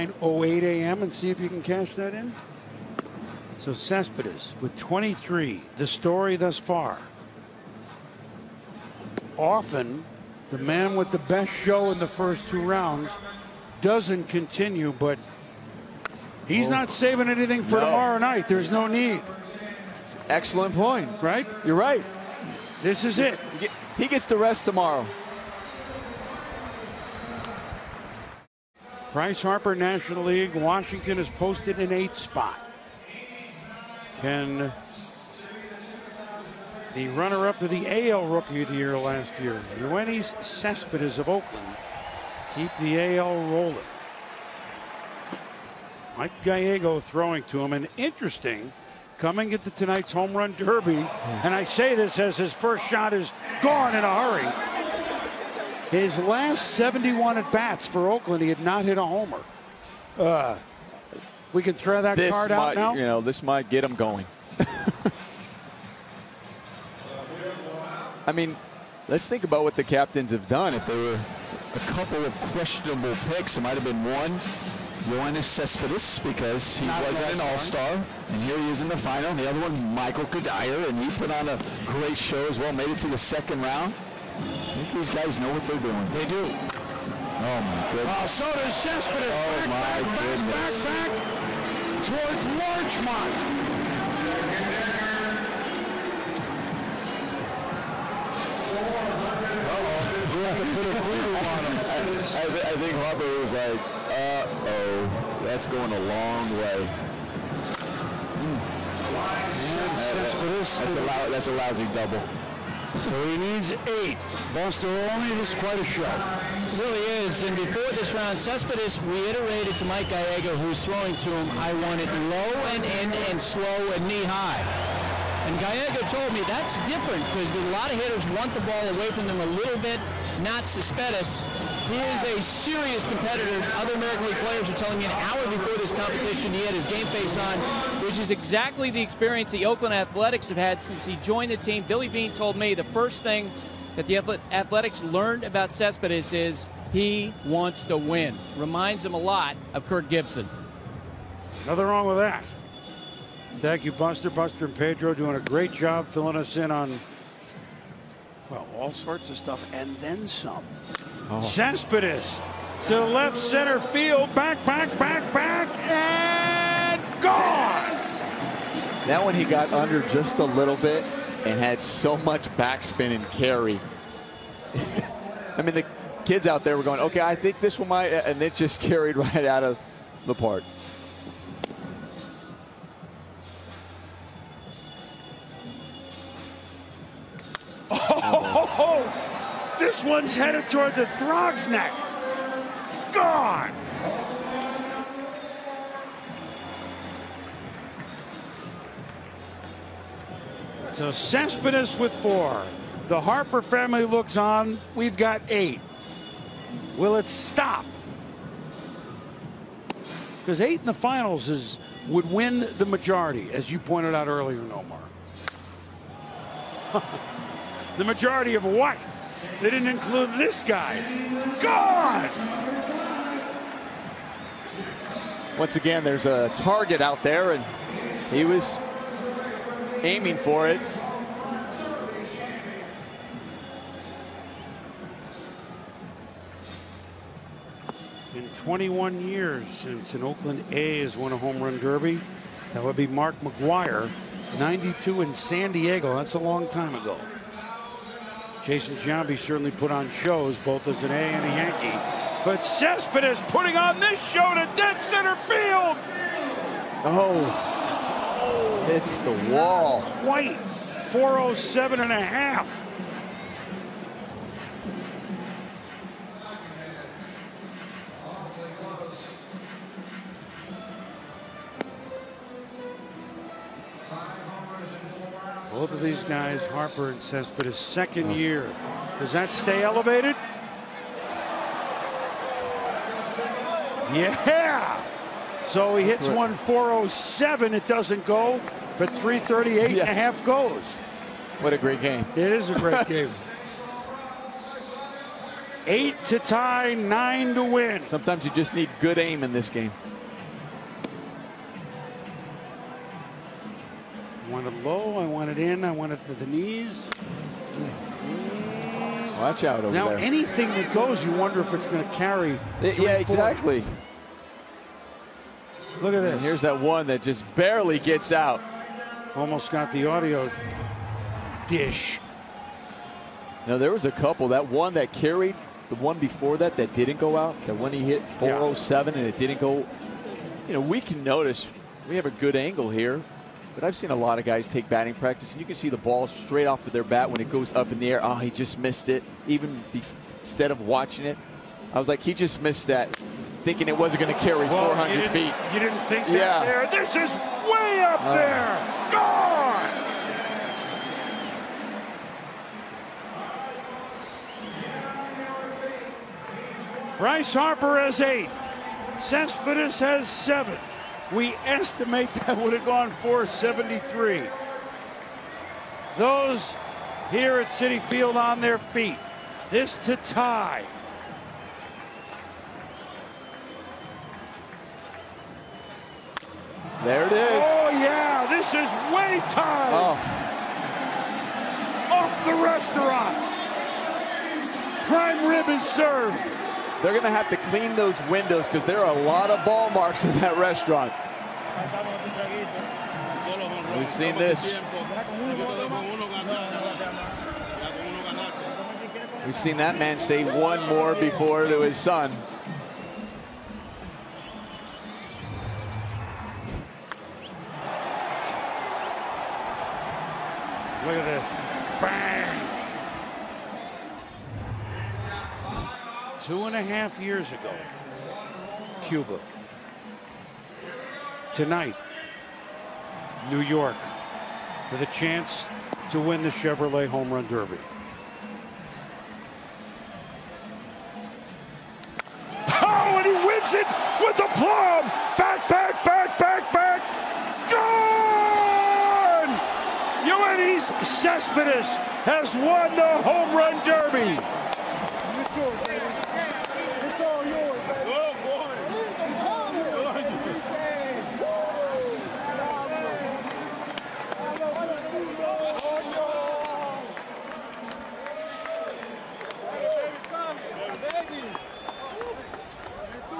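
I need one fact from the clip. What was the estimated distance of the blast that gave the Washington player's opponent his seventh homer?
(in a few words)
473.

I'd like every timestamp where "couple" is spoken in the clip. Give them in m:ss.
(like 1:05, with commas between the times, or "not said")
1:11, 5:24.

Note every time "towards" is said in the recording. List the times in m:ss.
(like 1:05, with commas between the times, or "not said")
1:32, 3:10.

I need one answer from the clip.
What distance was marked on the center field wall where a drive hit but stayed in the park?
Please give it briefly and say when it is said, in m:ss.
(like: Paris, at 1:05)
407 and a half, at 4:20.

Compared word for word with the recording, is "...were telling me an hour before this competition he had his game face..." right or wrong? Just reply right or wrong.
right.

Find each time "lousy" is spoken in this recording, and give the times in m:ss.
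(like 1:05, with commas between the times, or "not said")
1:51.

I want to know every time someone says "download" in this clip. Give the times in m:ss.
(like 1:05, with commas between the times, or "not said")
not said.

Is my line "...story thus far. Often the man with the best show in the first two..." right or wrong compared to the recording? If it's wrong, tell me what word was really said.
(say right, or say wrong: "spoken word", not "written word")
right.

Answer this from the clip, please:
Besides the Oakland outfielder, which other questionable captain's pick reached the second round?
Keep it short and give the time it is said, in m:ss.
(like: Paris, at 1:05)
Michael Cuddyer, at 1:19.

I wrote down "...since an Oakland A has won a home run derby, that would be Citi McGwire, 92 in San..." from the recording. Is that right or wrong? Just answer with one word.
wrong.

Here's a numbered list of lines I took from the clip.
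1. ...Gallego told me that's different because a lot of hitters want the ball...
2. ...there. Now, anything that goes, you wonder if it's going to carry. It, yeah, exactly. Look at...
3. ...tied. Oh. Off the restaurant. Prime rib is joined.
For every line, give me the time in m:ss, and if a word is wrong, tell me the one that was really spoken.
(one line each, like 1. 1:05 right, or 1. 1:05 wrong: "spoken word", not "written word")
1. 2:05 right
2. 5:10 right
3. 6:19 wrong: "served", not "joined".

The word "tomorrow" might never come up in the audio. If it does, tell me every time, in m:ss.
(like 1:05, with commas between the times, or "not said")
0:17, 0:24.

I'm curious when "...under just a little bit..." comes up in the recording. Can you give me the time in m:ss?
2:49.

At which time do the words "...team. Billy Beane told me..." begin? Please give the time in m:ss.
2:21.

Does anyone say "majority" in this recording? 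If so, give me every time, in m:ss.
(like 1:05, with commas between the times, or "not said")
3:32, 3:38.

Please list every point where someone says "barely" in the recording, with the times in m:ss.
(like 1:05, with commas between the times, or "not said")
5:17.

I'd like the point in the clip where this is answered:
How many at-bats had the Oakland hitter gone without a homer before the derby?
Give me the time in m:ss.
0:56.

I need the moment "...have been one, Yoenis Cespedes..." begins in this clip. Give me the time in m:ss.
1:13.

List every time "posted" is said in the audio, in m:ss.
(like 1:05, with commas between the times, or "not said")
0:31.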